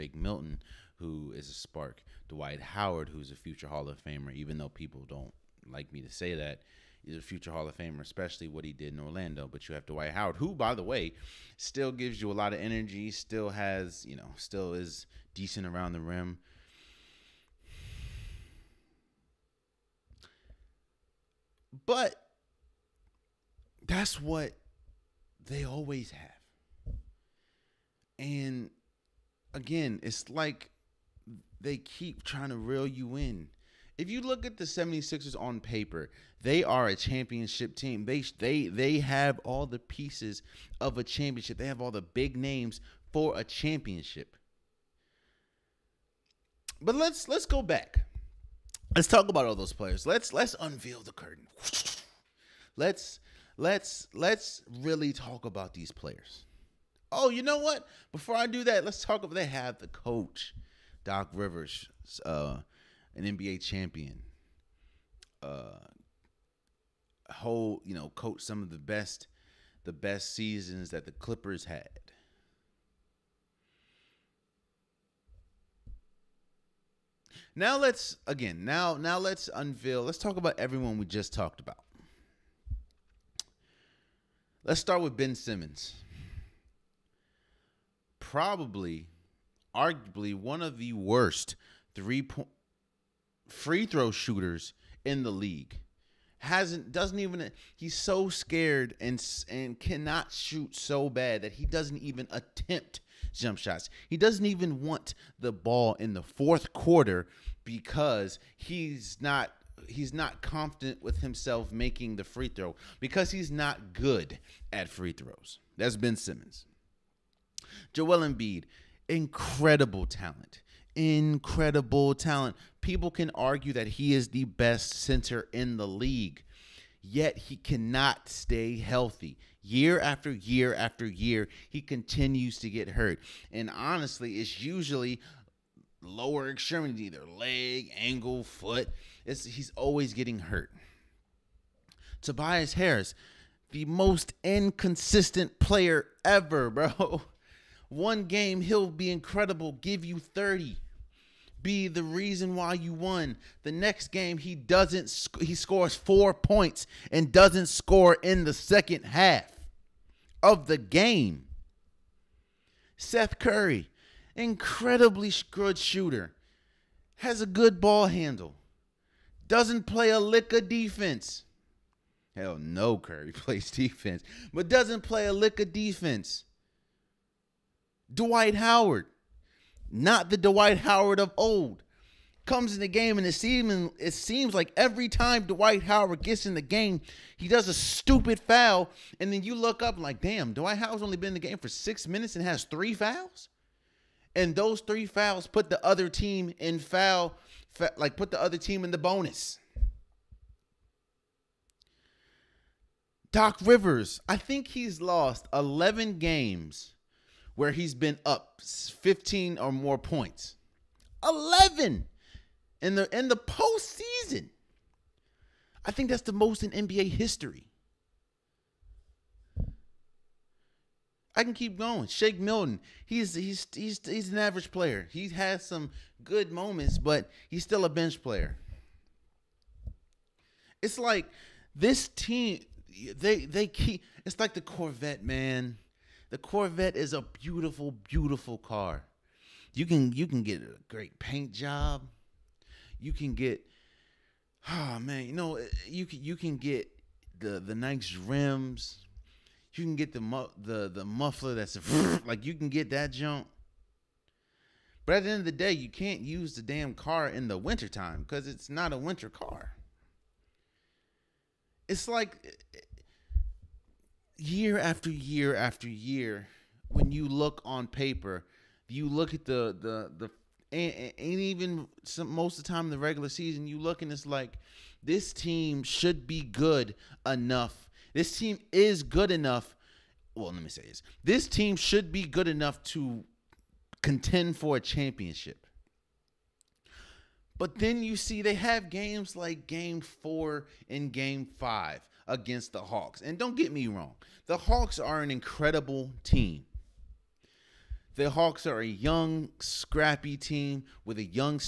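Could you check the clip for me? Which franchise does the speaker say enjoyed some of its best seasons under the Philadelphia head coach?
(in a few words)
Clippers.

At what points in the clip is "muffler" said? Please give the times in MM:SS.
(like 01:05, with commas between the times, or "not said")
04:11.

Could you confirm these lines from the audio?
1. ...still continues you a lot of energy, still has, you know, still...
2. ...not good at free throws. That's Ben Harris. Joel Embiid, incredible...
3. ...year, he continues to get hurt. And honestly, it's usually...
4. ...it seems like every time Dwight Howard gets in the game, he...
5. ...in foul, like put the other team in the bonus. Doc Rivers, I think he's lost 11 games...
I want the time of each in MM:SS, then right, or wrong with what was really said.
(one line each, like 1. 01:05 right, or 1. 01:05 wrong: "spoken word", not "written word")
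1. 00:11 wrong: "gives", not "continues"
2. 01:53 wrong: "Simmons", not "Harris"
3. 02:11 right
4. 03:03 right
5. 03:16 right.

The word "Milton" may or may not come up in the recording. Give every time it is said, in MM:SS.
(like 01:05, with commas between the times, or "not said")
00:00, 03:42.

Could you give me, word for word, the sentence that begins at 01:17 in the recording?
Now let's again now now let's unveil.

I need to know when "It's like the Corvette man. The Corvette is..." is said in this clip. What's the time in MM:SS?
03:54.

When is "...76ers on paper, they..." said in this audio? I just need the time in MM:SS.
00:34.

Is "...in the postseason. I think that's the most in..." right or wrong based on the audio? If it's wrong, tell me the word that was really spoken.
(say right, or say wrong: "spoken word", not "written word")
right.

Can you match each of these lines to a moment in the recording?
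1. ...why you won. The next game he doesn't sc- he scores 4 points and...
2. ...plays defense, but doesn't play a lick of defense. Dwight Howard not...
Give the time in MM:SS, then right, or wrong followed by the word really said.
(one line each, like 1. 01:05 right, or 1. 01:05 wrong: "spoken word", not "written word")
1. 02:32 right
2. 02:53 right.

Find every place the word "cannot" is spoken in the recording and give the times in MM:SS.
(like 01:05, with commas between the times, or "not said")
01:39, 02:07.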